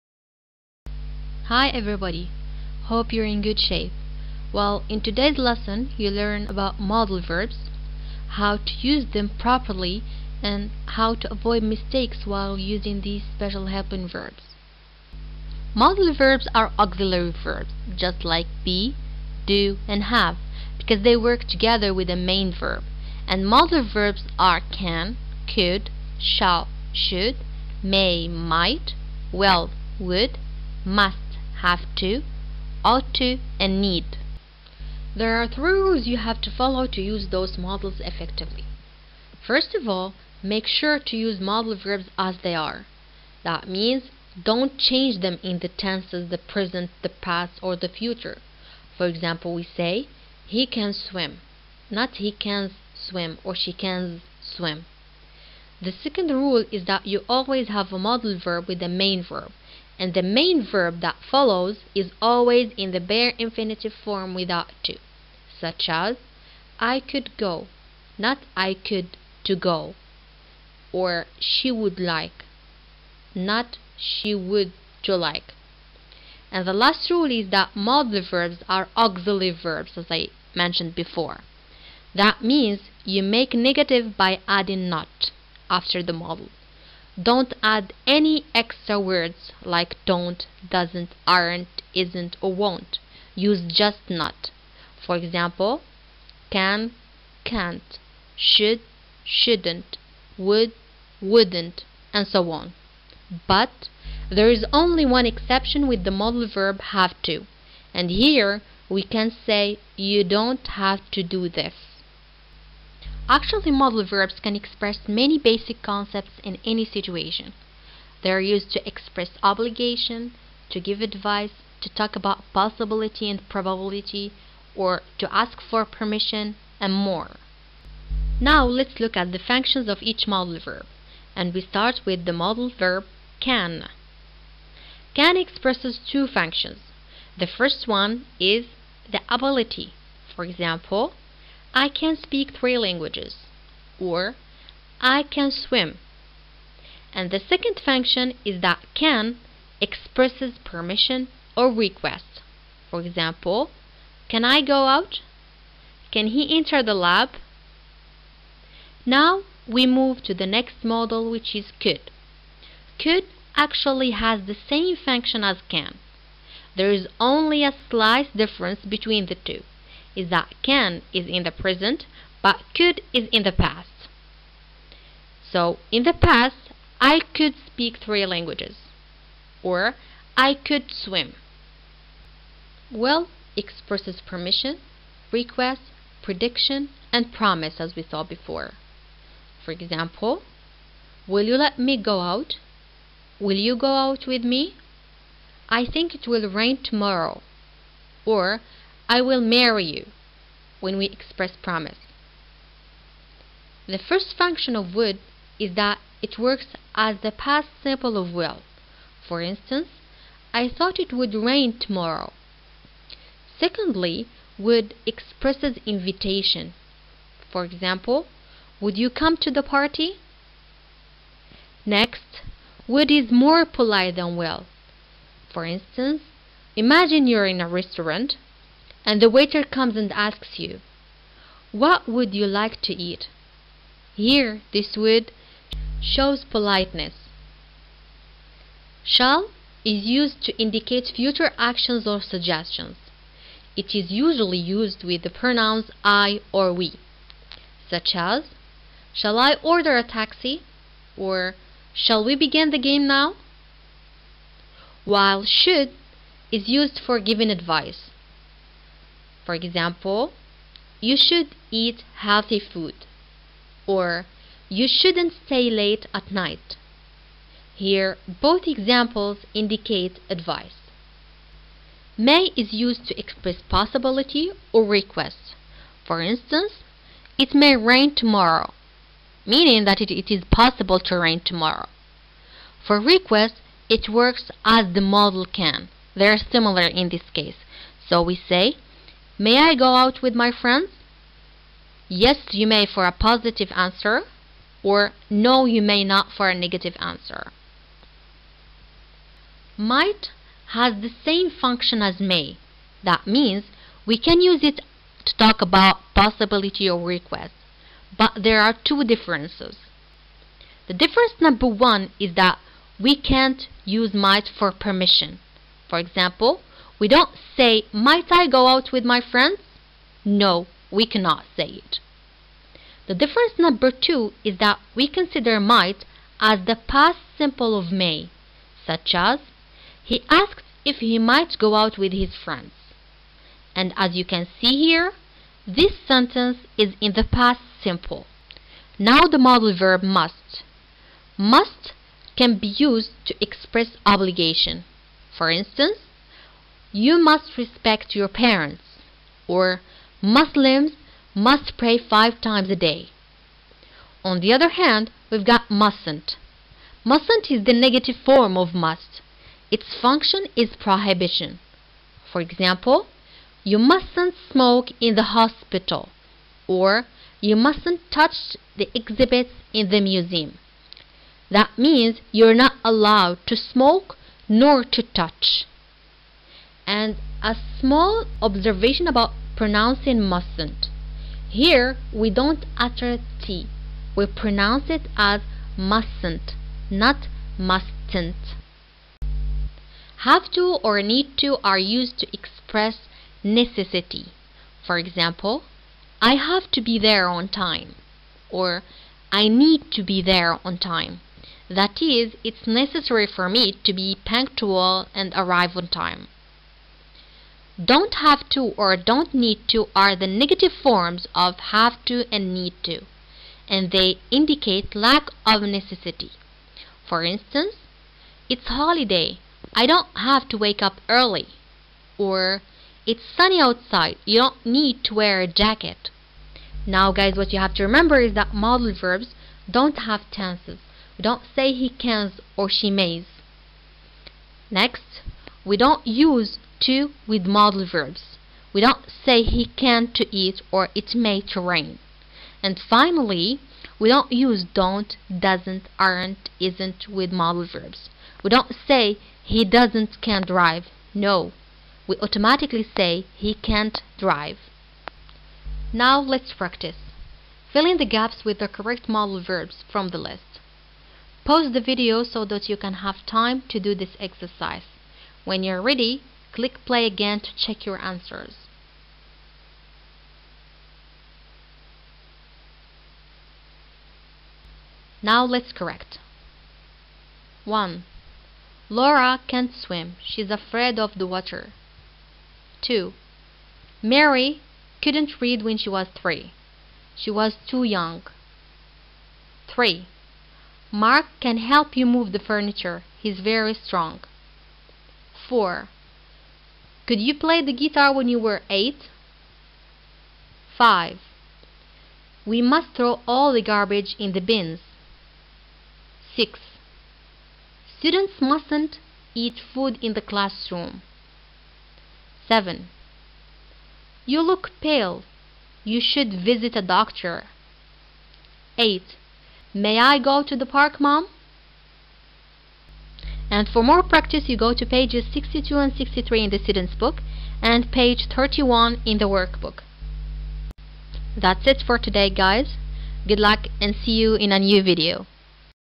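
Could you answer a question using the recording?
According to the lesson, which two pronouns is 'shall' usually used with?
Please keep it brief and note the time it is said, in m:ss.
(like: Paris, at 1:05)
I or we, at 4:06.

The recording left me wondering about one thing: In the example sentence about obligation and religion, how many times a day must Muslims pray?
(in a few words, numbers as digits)
5.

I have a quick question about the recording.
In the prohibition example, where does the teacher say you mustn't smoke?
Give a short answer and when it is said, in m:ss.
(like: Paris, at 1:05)
in the hospital, at 6:04.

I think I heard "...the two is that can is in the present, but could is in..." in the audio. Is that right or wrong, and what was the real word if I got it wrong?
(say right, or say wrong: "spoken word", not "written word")
right.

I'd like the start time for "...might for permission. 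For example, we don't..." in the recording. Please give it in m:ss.
5:14.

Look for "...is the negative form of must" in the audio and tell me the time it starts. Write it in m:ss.
5:57.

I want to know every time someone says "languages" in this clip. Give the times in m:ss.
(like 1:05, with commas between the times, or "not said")
2:22, 2:58.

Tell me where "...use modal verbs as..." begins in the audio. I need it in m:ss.
0:41.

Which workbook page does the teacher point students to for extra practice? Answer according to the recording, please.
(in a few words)
31.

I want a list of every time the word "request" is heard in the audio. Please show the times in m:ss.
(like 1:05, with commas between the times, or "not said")
2:31, 3:05, 4:34, 4:43, 5:07.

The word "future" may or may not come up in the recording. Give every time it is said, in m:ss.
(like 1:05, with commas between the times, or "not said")
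0:48, 4:01.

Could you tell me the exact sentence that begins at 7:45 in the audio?
When you're ready, Click play again to check your answers.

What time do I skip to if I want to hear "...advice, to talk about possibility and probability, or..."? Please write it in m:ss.
2:01.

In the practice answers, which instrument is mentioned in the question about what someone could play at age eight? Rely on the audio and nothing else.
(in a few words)
guitar.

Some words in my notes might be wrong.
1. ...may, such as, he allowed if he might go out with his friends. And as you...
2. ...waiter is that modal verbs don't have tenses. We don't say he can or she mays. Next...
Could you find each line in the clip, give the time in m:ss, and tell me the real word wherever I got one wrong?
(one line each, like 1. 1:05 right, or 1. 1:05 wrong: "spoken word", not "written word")
1. 5:27 wrong: "asked", not "allowed"
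2. 7:07 wrong: "remember", not "waiter".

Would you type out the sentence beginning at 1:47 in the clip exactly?
And here we can say you don't have to do this.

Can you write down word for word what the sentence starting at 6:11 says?
That means you're not allowed to smoke nor to touch and a small observation about pronouncing mustn't.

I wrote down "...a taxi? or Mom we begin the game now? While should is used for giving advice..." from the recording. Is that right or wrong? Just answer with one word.
wrong.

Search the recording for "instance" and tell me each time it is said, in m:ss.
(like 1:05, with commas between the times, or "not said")
3:29, 3:45, 4:36, 5:45, 6:57.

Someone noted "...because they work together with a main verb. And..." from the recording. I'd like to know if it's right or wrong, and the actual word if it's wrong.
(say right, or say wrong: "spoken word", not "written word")
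right.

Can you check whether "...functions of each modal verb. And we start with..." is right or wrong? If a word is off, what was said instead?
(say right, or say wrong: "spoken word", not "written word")
right.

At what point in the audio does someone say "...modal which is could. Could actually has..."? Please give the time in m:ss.
2:40.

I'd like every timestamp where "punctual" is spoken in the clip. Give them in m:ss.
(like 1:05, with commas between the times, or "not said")
6:44.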